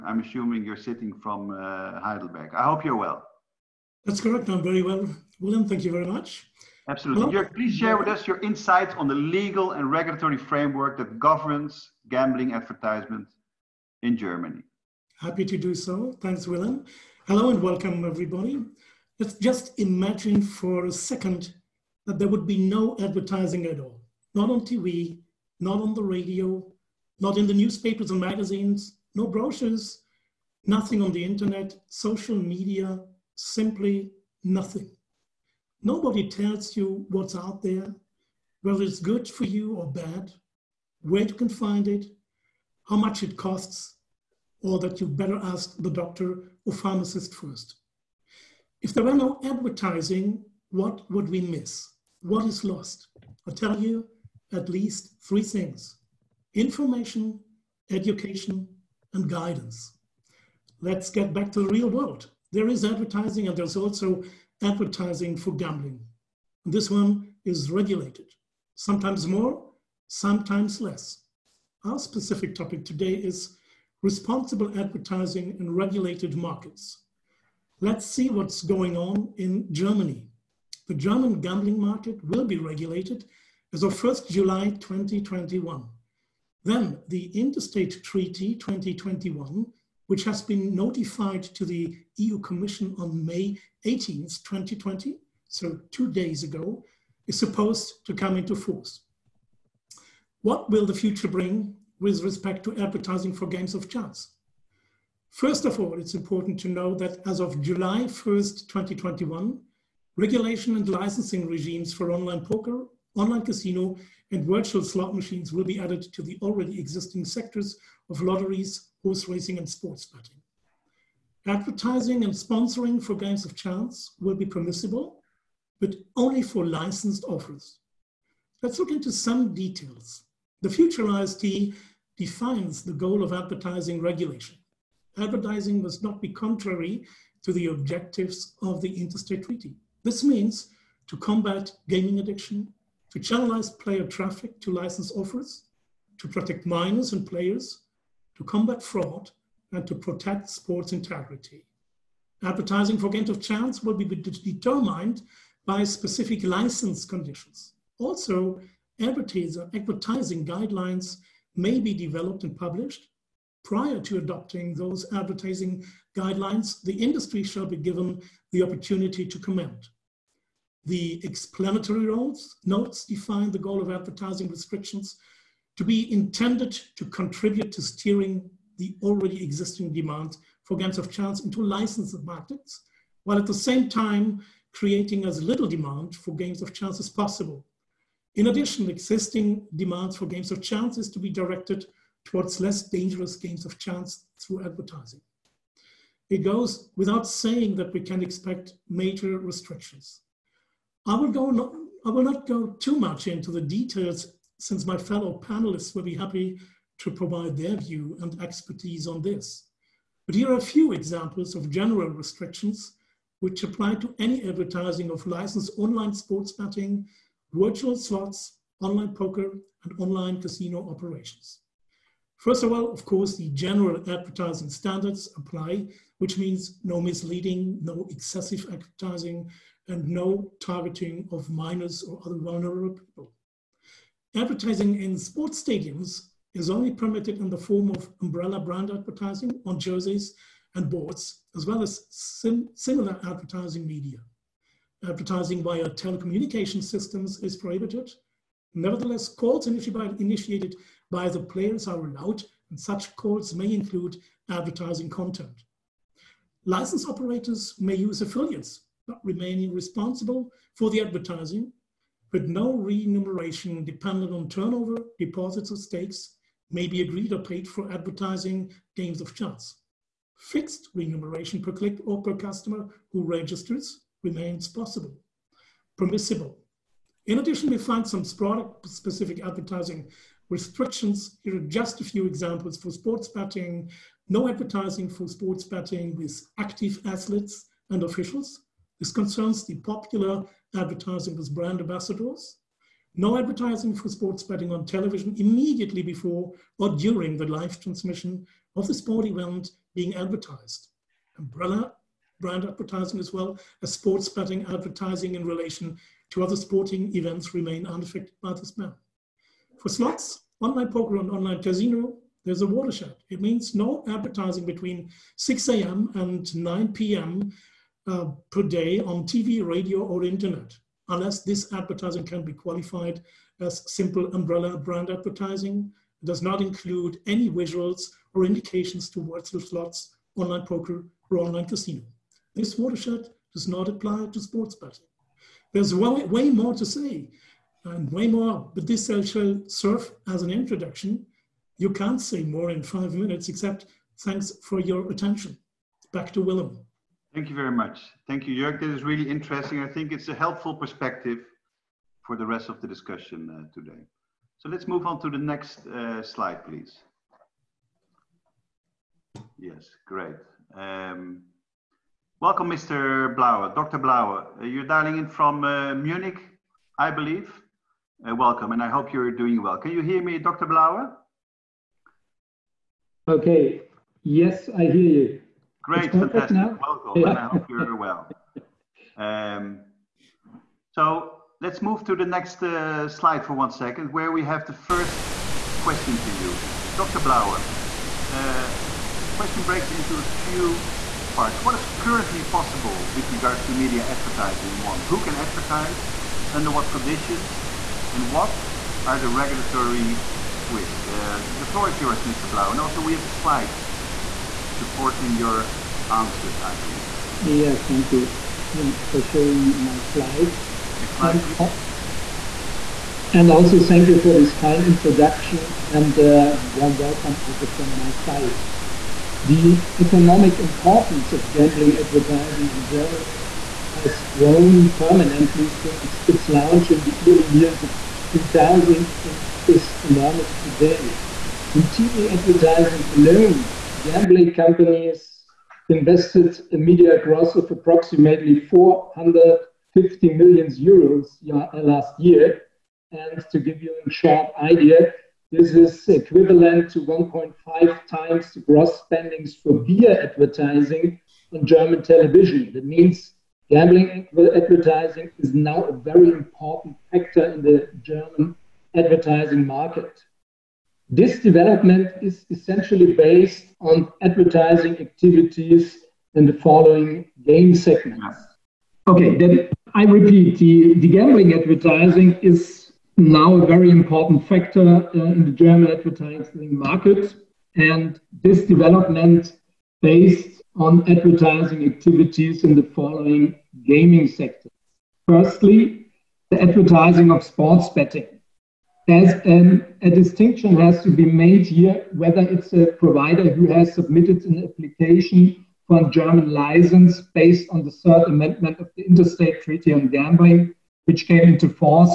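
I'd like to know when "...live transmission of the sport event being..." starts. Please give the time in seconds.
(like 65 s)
297 s.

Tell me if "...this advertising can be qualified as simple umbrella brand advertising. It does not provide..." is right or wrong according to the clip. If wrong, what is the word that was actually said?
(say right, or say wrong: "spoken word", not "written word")
wrong: "include", not "provide".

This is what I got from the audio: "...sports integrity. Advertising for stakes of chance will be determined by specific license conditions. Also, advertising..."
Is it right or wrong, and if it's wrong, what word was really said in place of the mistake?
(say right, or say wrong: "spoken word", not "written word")
wrong: "games", not "stakes".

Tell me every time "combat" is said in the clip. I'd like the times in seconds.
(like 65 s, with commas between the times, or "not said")
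141 s, 148 s.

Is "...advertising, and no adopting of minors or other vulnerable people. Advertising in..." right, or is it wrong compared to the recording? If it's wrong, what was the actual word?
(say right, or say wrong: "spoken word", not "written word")
wrong: "targeting", not "adopting".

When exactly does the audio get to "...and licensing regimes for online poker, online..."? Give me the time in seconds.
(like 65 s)
110 s.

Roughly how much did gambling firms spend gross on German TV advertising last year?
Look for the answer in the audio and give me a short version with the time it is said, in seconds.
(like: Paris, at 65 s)
450 million euros, at 438 s.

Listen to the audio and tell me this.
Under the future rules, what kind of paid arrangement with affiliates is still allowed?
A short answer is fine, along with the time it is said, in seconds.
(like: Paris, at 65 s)
Fixed remuneration per click, at 270 s.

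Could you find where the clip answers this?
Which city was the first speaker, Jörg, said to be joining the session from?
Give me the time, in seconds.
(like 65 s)
1 s.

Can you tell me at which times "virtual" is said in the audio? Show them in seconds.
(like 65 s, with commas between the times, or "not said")
114 s, 217 s.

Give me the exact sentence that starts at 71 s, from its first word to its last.
Our specific topic today is responsible advertising in regulated markets.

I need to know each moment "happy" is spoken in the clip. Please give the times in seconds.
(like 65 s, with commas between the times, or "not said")
15 s, 206 s.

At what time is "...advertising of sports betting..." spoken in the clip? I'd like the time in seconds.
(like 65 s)
486 s.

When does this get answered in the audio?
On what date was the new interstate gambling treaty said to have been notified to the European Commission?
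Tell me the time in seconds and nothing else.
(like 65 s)
93 s.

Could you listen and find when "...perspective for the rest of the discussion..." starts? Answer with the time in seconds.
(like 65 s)
350 s.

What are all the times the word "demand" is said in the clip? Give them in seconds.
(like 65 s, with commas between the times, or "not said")
179 s, 185 s, 189 s.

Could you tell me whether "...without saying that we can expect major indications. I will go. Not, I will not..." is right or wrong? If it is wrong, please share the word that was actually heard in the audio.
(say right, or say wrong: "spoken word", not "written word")
wrong: "restrictions", not "indications".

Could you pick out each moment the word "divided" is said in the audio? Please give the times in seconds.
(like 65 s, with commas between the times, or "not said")
not said.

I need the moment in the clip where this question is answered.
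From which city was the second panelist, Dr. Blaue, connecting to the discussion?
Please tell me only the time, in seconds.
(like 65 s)
365 s.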